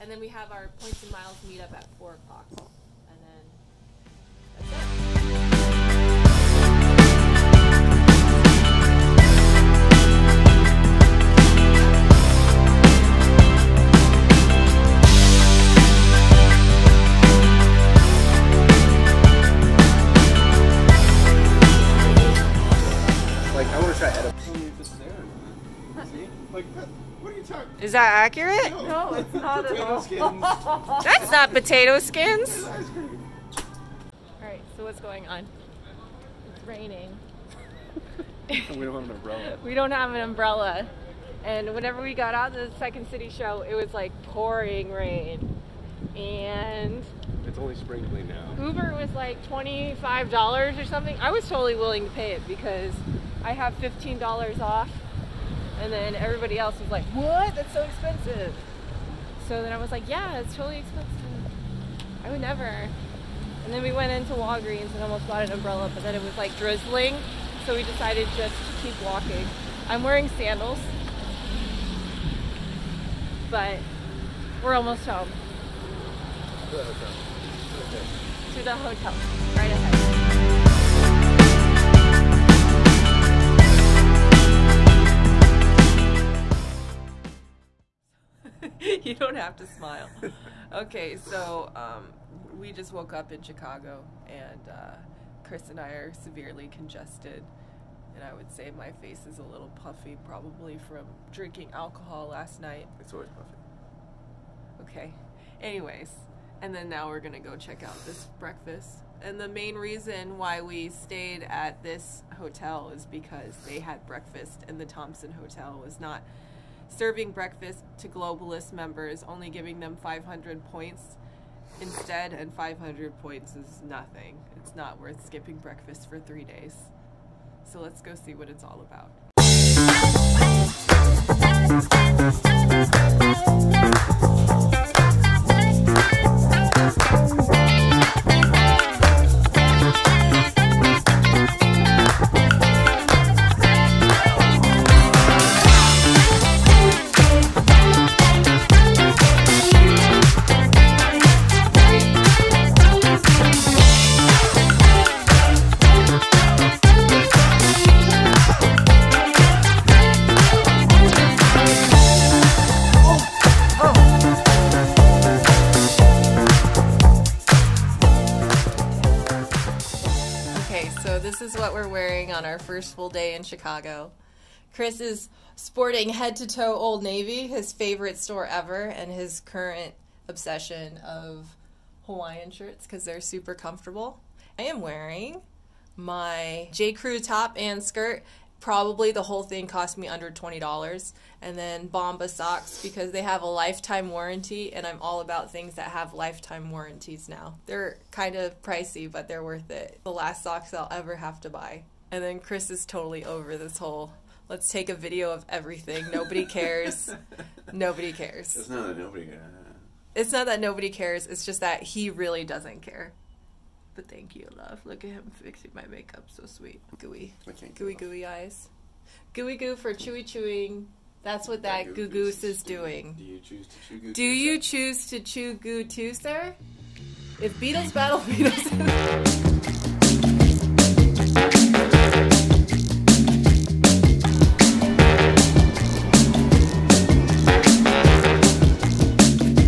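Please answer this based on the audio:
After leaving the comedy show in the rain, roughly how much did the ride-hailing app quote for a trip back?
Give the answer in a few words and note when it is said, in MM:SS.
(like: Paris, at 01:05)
$25, at 00:49.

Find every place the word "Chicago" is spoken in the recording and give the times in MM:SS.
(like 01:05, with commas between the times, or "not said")
01:33, 02:53.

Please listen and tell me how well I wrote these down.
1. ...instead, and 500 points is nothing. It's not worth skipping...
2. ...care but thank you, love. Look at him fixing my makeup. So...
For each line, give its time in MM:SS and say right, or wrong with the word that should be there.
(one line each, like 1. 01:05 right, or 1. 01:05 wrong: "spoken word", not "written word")
1. 02:01 right
2. 03:32 right.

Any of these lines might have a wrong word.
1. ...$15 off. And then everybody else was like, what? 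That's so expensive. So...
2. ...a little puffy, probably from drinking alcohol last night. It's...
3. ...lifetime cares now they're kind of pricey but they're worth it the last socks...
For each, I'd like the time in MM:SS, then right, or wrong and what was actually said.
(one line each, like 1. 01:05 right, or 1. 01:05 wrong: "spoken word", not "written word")
1. 00:53 right
2. 01:39 right
3. 03:16 wrong: "warranties", not "cares".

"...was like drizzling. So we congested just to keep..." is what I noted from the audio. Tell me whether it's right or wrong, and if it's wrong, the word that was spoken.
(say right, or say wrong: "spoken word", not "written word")
wrong: "decided", not "congested".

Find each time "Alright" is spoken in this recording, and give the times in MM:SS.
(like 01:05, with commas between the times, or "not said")
00:34.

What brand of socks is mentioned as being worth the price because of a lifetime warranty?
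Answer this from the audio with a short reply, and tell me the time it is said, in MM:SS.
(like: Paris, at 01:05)
Bombas, at 03:11.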